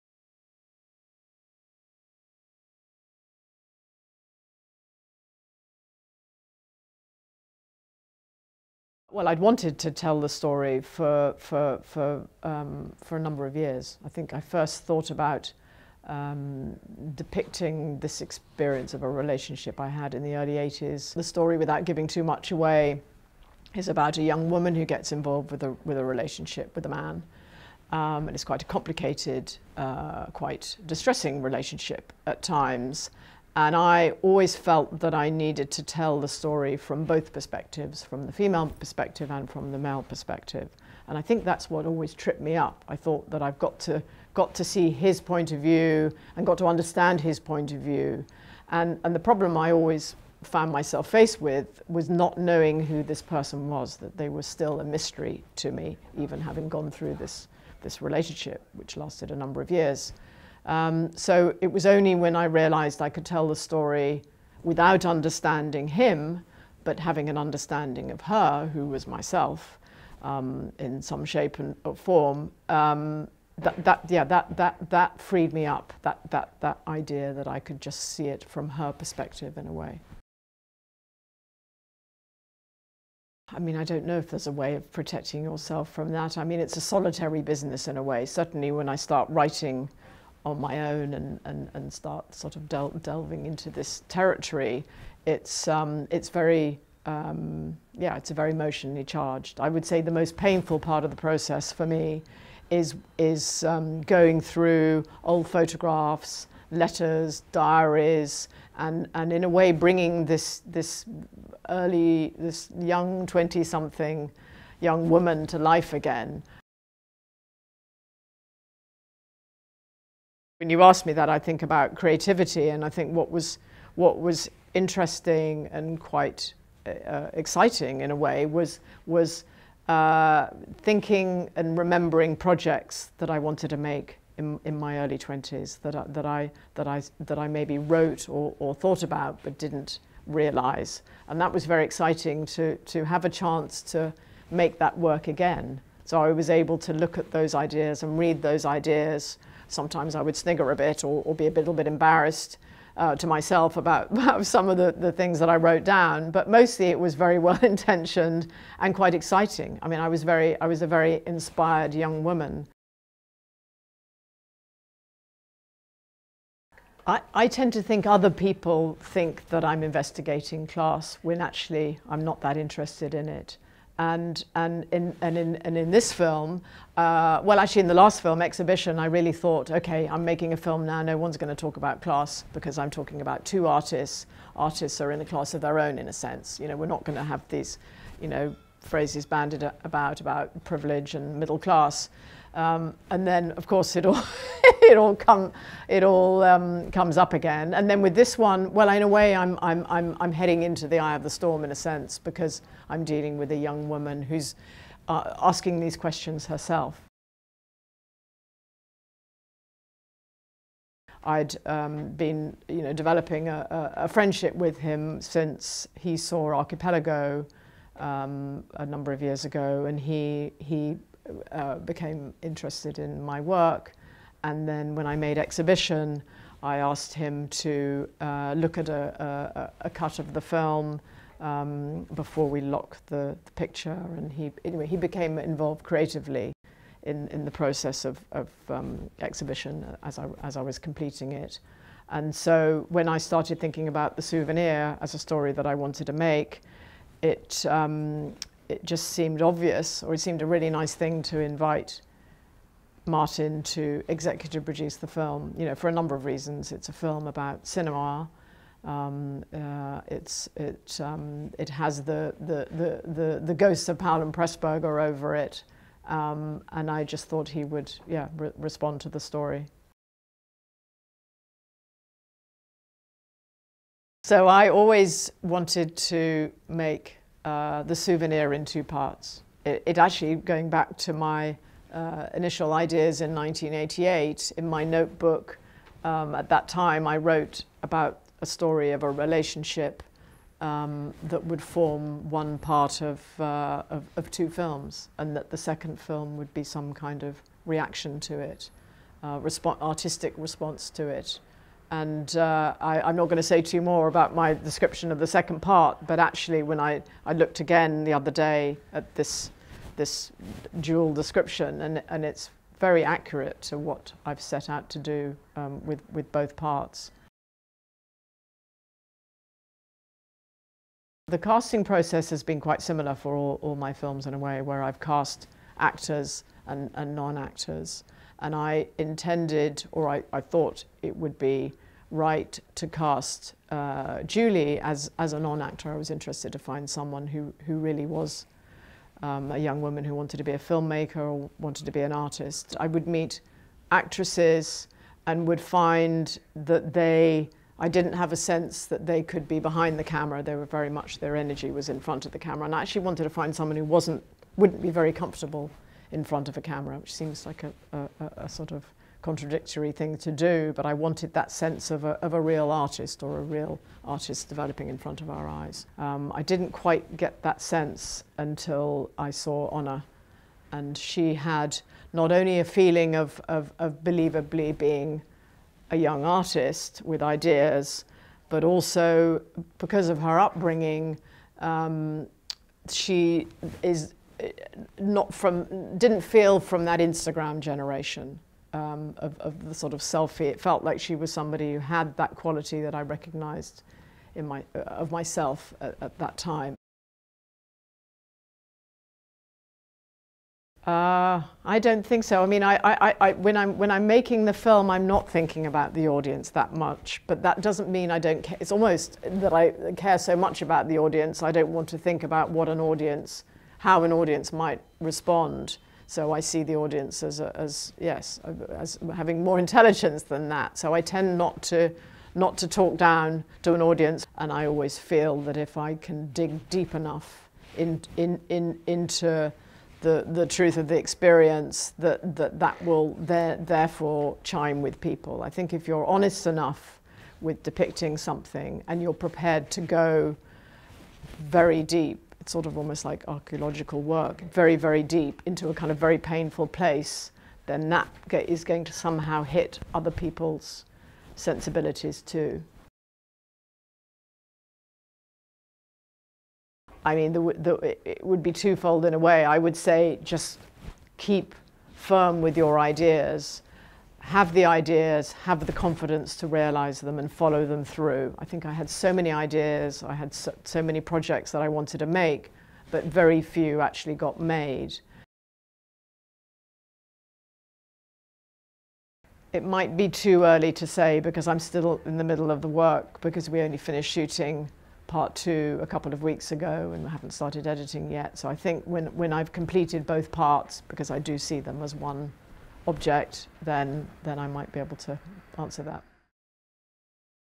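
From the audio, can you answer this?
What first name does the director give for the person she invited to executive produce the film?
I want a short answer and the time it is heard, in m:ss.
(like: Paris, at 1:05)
Martin, at 4:13.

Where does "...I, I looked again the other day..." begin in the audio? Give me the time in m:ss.
5:06.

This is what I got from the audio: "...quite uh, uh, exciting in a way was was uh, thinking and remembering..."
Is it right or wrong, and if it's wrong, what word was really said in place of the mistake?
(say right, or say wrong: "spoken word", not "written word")
right.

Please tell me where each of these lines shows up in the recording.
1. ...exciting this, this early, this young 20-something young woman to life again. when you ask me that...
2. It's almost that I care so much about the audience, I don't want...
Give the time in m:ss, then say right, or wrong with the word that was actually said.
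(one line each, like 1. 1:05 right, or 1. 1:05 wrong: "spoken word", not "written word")
1. 1:49 wrong: "bringing", not "exciting"
2. 6:48 right.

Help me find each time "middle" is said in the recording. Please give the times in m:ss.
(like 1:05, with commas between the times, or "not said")
3:11, 8:02.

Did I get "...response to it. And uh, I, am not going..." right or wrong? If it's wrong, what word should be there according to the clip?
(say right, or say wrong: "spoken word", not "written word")
right.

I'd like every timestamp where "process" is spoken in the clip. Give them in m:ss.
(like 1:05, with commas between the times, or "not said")
1:41, 3:57, 5:21.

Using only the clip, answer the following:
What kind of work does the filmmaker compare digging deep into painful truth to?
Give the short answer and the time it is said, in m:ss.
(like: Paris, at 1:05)
archaeological work, at 7:23.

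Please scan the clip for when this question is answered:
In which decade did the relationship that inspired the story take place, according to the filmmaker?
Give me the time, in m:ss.
0:20.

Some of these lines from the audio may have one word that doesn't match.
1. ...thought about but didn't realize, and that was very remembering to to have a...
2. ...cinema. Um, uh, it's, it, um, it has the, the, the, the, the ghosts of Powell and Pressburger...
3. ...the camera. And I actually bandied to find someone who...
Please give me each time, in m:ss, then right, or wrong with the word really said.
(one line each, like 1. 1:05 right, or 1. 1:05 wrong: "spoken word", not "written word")
1. 2:18 wrong: "exciting", not "remembering"
2. 4:17 right
3. 5:52 wrong: "wanted", not "bandied".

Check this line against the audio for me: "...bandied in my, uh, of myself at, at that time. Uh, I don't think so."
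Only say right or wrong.
wrong.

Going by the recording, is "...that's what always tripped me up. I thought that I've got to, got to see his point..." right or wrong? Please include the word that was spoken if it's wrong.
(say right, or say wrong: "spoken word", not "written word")
right.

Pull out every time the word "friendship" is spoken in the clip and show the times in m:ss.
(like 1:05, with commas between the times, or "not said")
3:34.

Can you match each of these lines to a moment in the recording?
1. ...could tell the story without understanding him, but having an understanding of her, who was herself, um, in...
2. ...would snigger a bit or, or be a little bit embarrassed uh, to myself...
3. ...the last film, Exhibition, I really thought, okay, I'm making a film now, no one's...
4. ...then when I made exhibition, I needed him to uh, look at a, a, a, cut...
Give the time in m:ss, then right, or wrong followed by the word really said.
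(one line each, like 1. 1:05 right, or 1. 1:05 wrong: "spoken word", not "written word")
1. 1:03 wrong: "myself", not "herself"
2. 2:30 right
3. 2:57 right
4. 3:44 wrong: "asked", not "needed".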